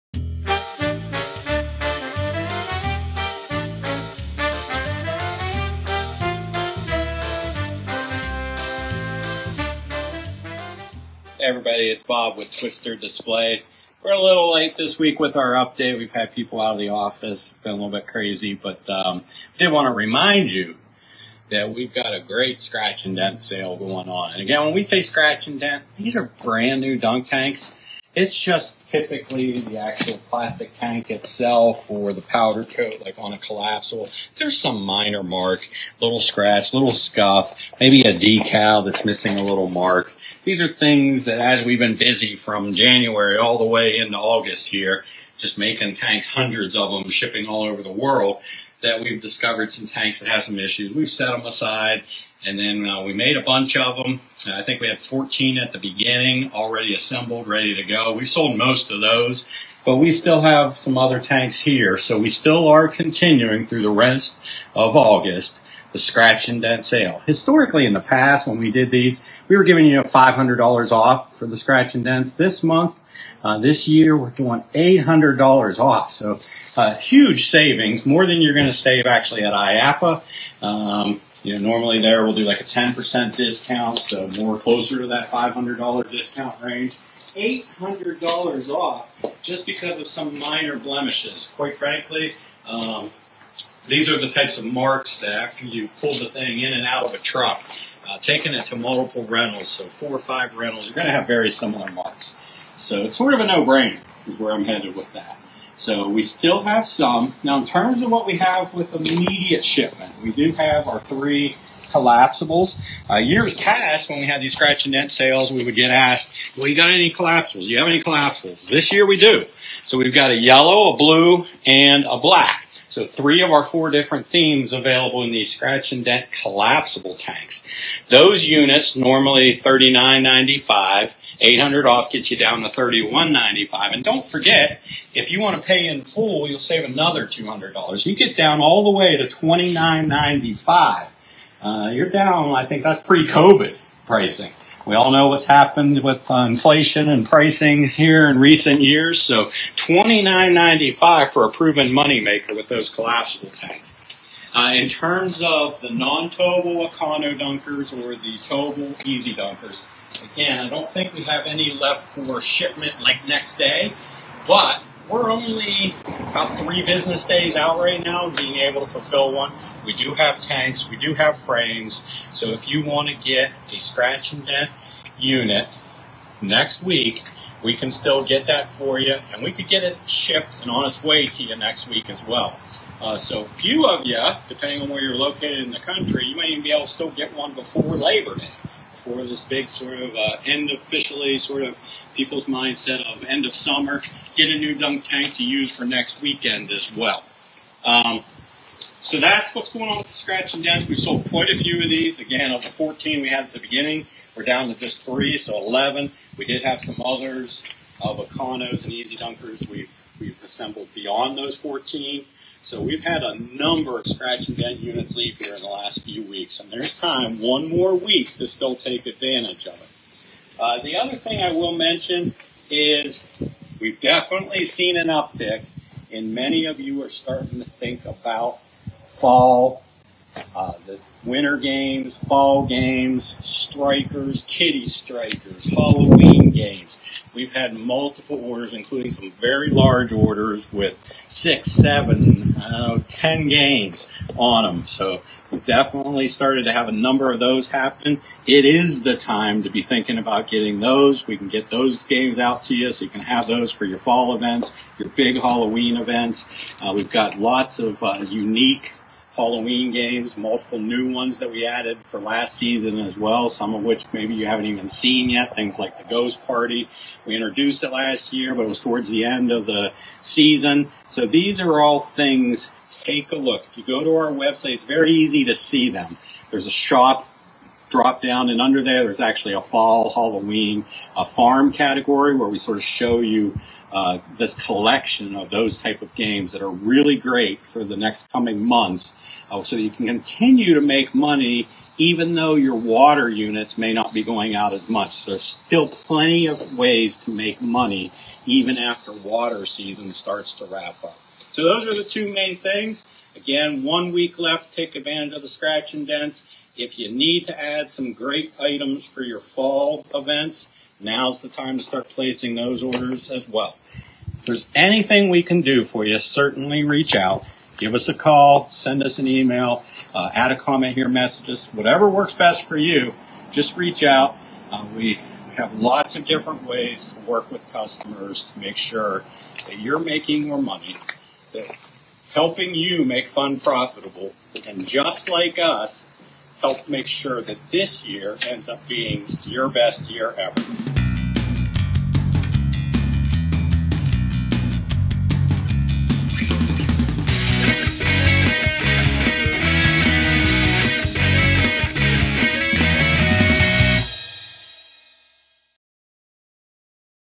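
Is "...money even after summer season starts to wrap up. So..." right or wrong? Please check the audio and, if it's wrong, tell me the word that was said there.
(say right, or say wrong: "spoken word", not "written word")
wrong: "water", not "summer".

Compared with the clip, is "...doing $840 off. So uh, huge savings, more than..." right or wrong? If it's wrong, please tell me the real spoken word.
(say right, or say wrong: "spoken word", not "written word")
wrong: "800", not "840".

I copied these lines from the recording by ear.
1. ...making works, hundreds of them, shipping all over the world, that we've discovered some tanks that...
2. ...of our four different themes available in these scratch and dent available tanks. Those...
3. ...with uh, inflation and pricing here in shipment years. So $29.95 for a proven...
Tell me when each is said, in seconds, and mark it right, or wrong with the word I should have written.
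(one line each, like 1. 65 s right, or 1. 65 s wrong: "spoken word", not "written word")
1. 45 s wrong: "tanks", not "works"
2. 123 s wrong: "collapsible", not "available"
3. 146 s wrong: "recent", not "shipment".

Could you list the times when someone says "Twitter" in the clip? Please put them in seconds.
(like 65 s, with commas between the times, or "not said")
not said.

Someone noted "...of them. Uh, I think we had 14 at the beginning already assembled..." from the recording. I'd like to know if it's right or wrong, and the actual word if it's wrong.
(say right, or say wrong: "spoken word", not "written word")
right.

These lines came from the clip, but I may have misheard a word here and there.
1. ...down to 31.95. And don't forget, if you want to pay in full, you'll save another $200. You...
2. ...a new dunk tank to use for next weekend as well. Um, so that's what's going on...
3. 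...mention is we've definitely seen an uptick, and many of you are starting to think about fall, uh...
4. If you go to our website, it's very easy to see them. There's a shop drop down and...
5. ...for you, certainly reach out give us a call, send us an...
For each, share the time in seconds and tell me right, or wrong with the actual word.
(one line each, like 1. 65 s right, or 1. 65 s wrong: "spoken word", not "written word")
1. 132 s right
2. 194 s right
3. 221 s right
4. 273 s right
5. 315 s right.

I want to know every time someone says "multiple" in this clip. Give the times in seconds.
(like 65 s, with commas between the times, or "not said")
98 s, 237 s, 260 s.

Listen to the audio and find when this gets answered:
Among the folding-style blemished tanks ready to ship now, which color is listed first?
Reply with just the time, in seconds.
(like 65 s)
120 s.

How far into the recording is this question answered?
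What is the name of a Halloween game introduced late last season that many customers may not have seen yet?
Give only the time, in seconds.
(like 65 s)
265 s.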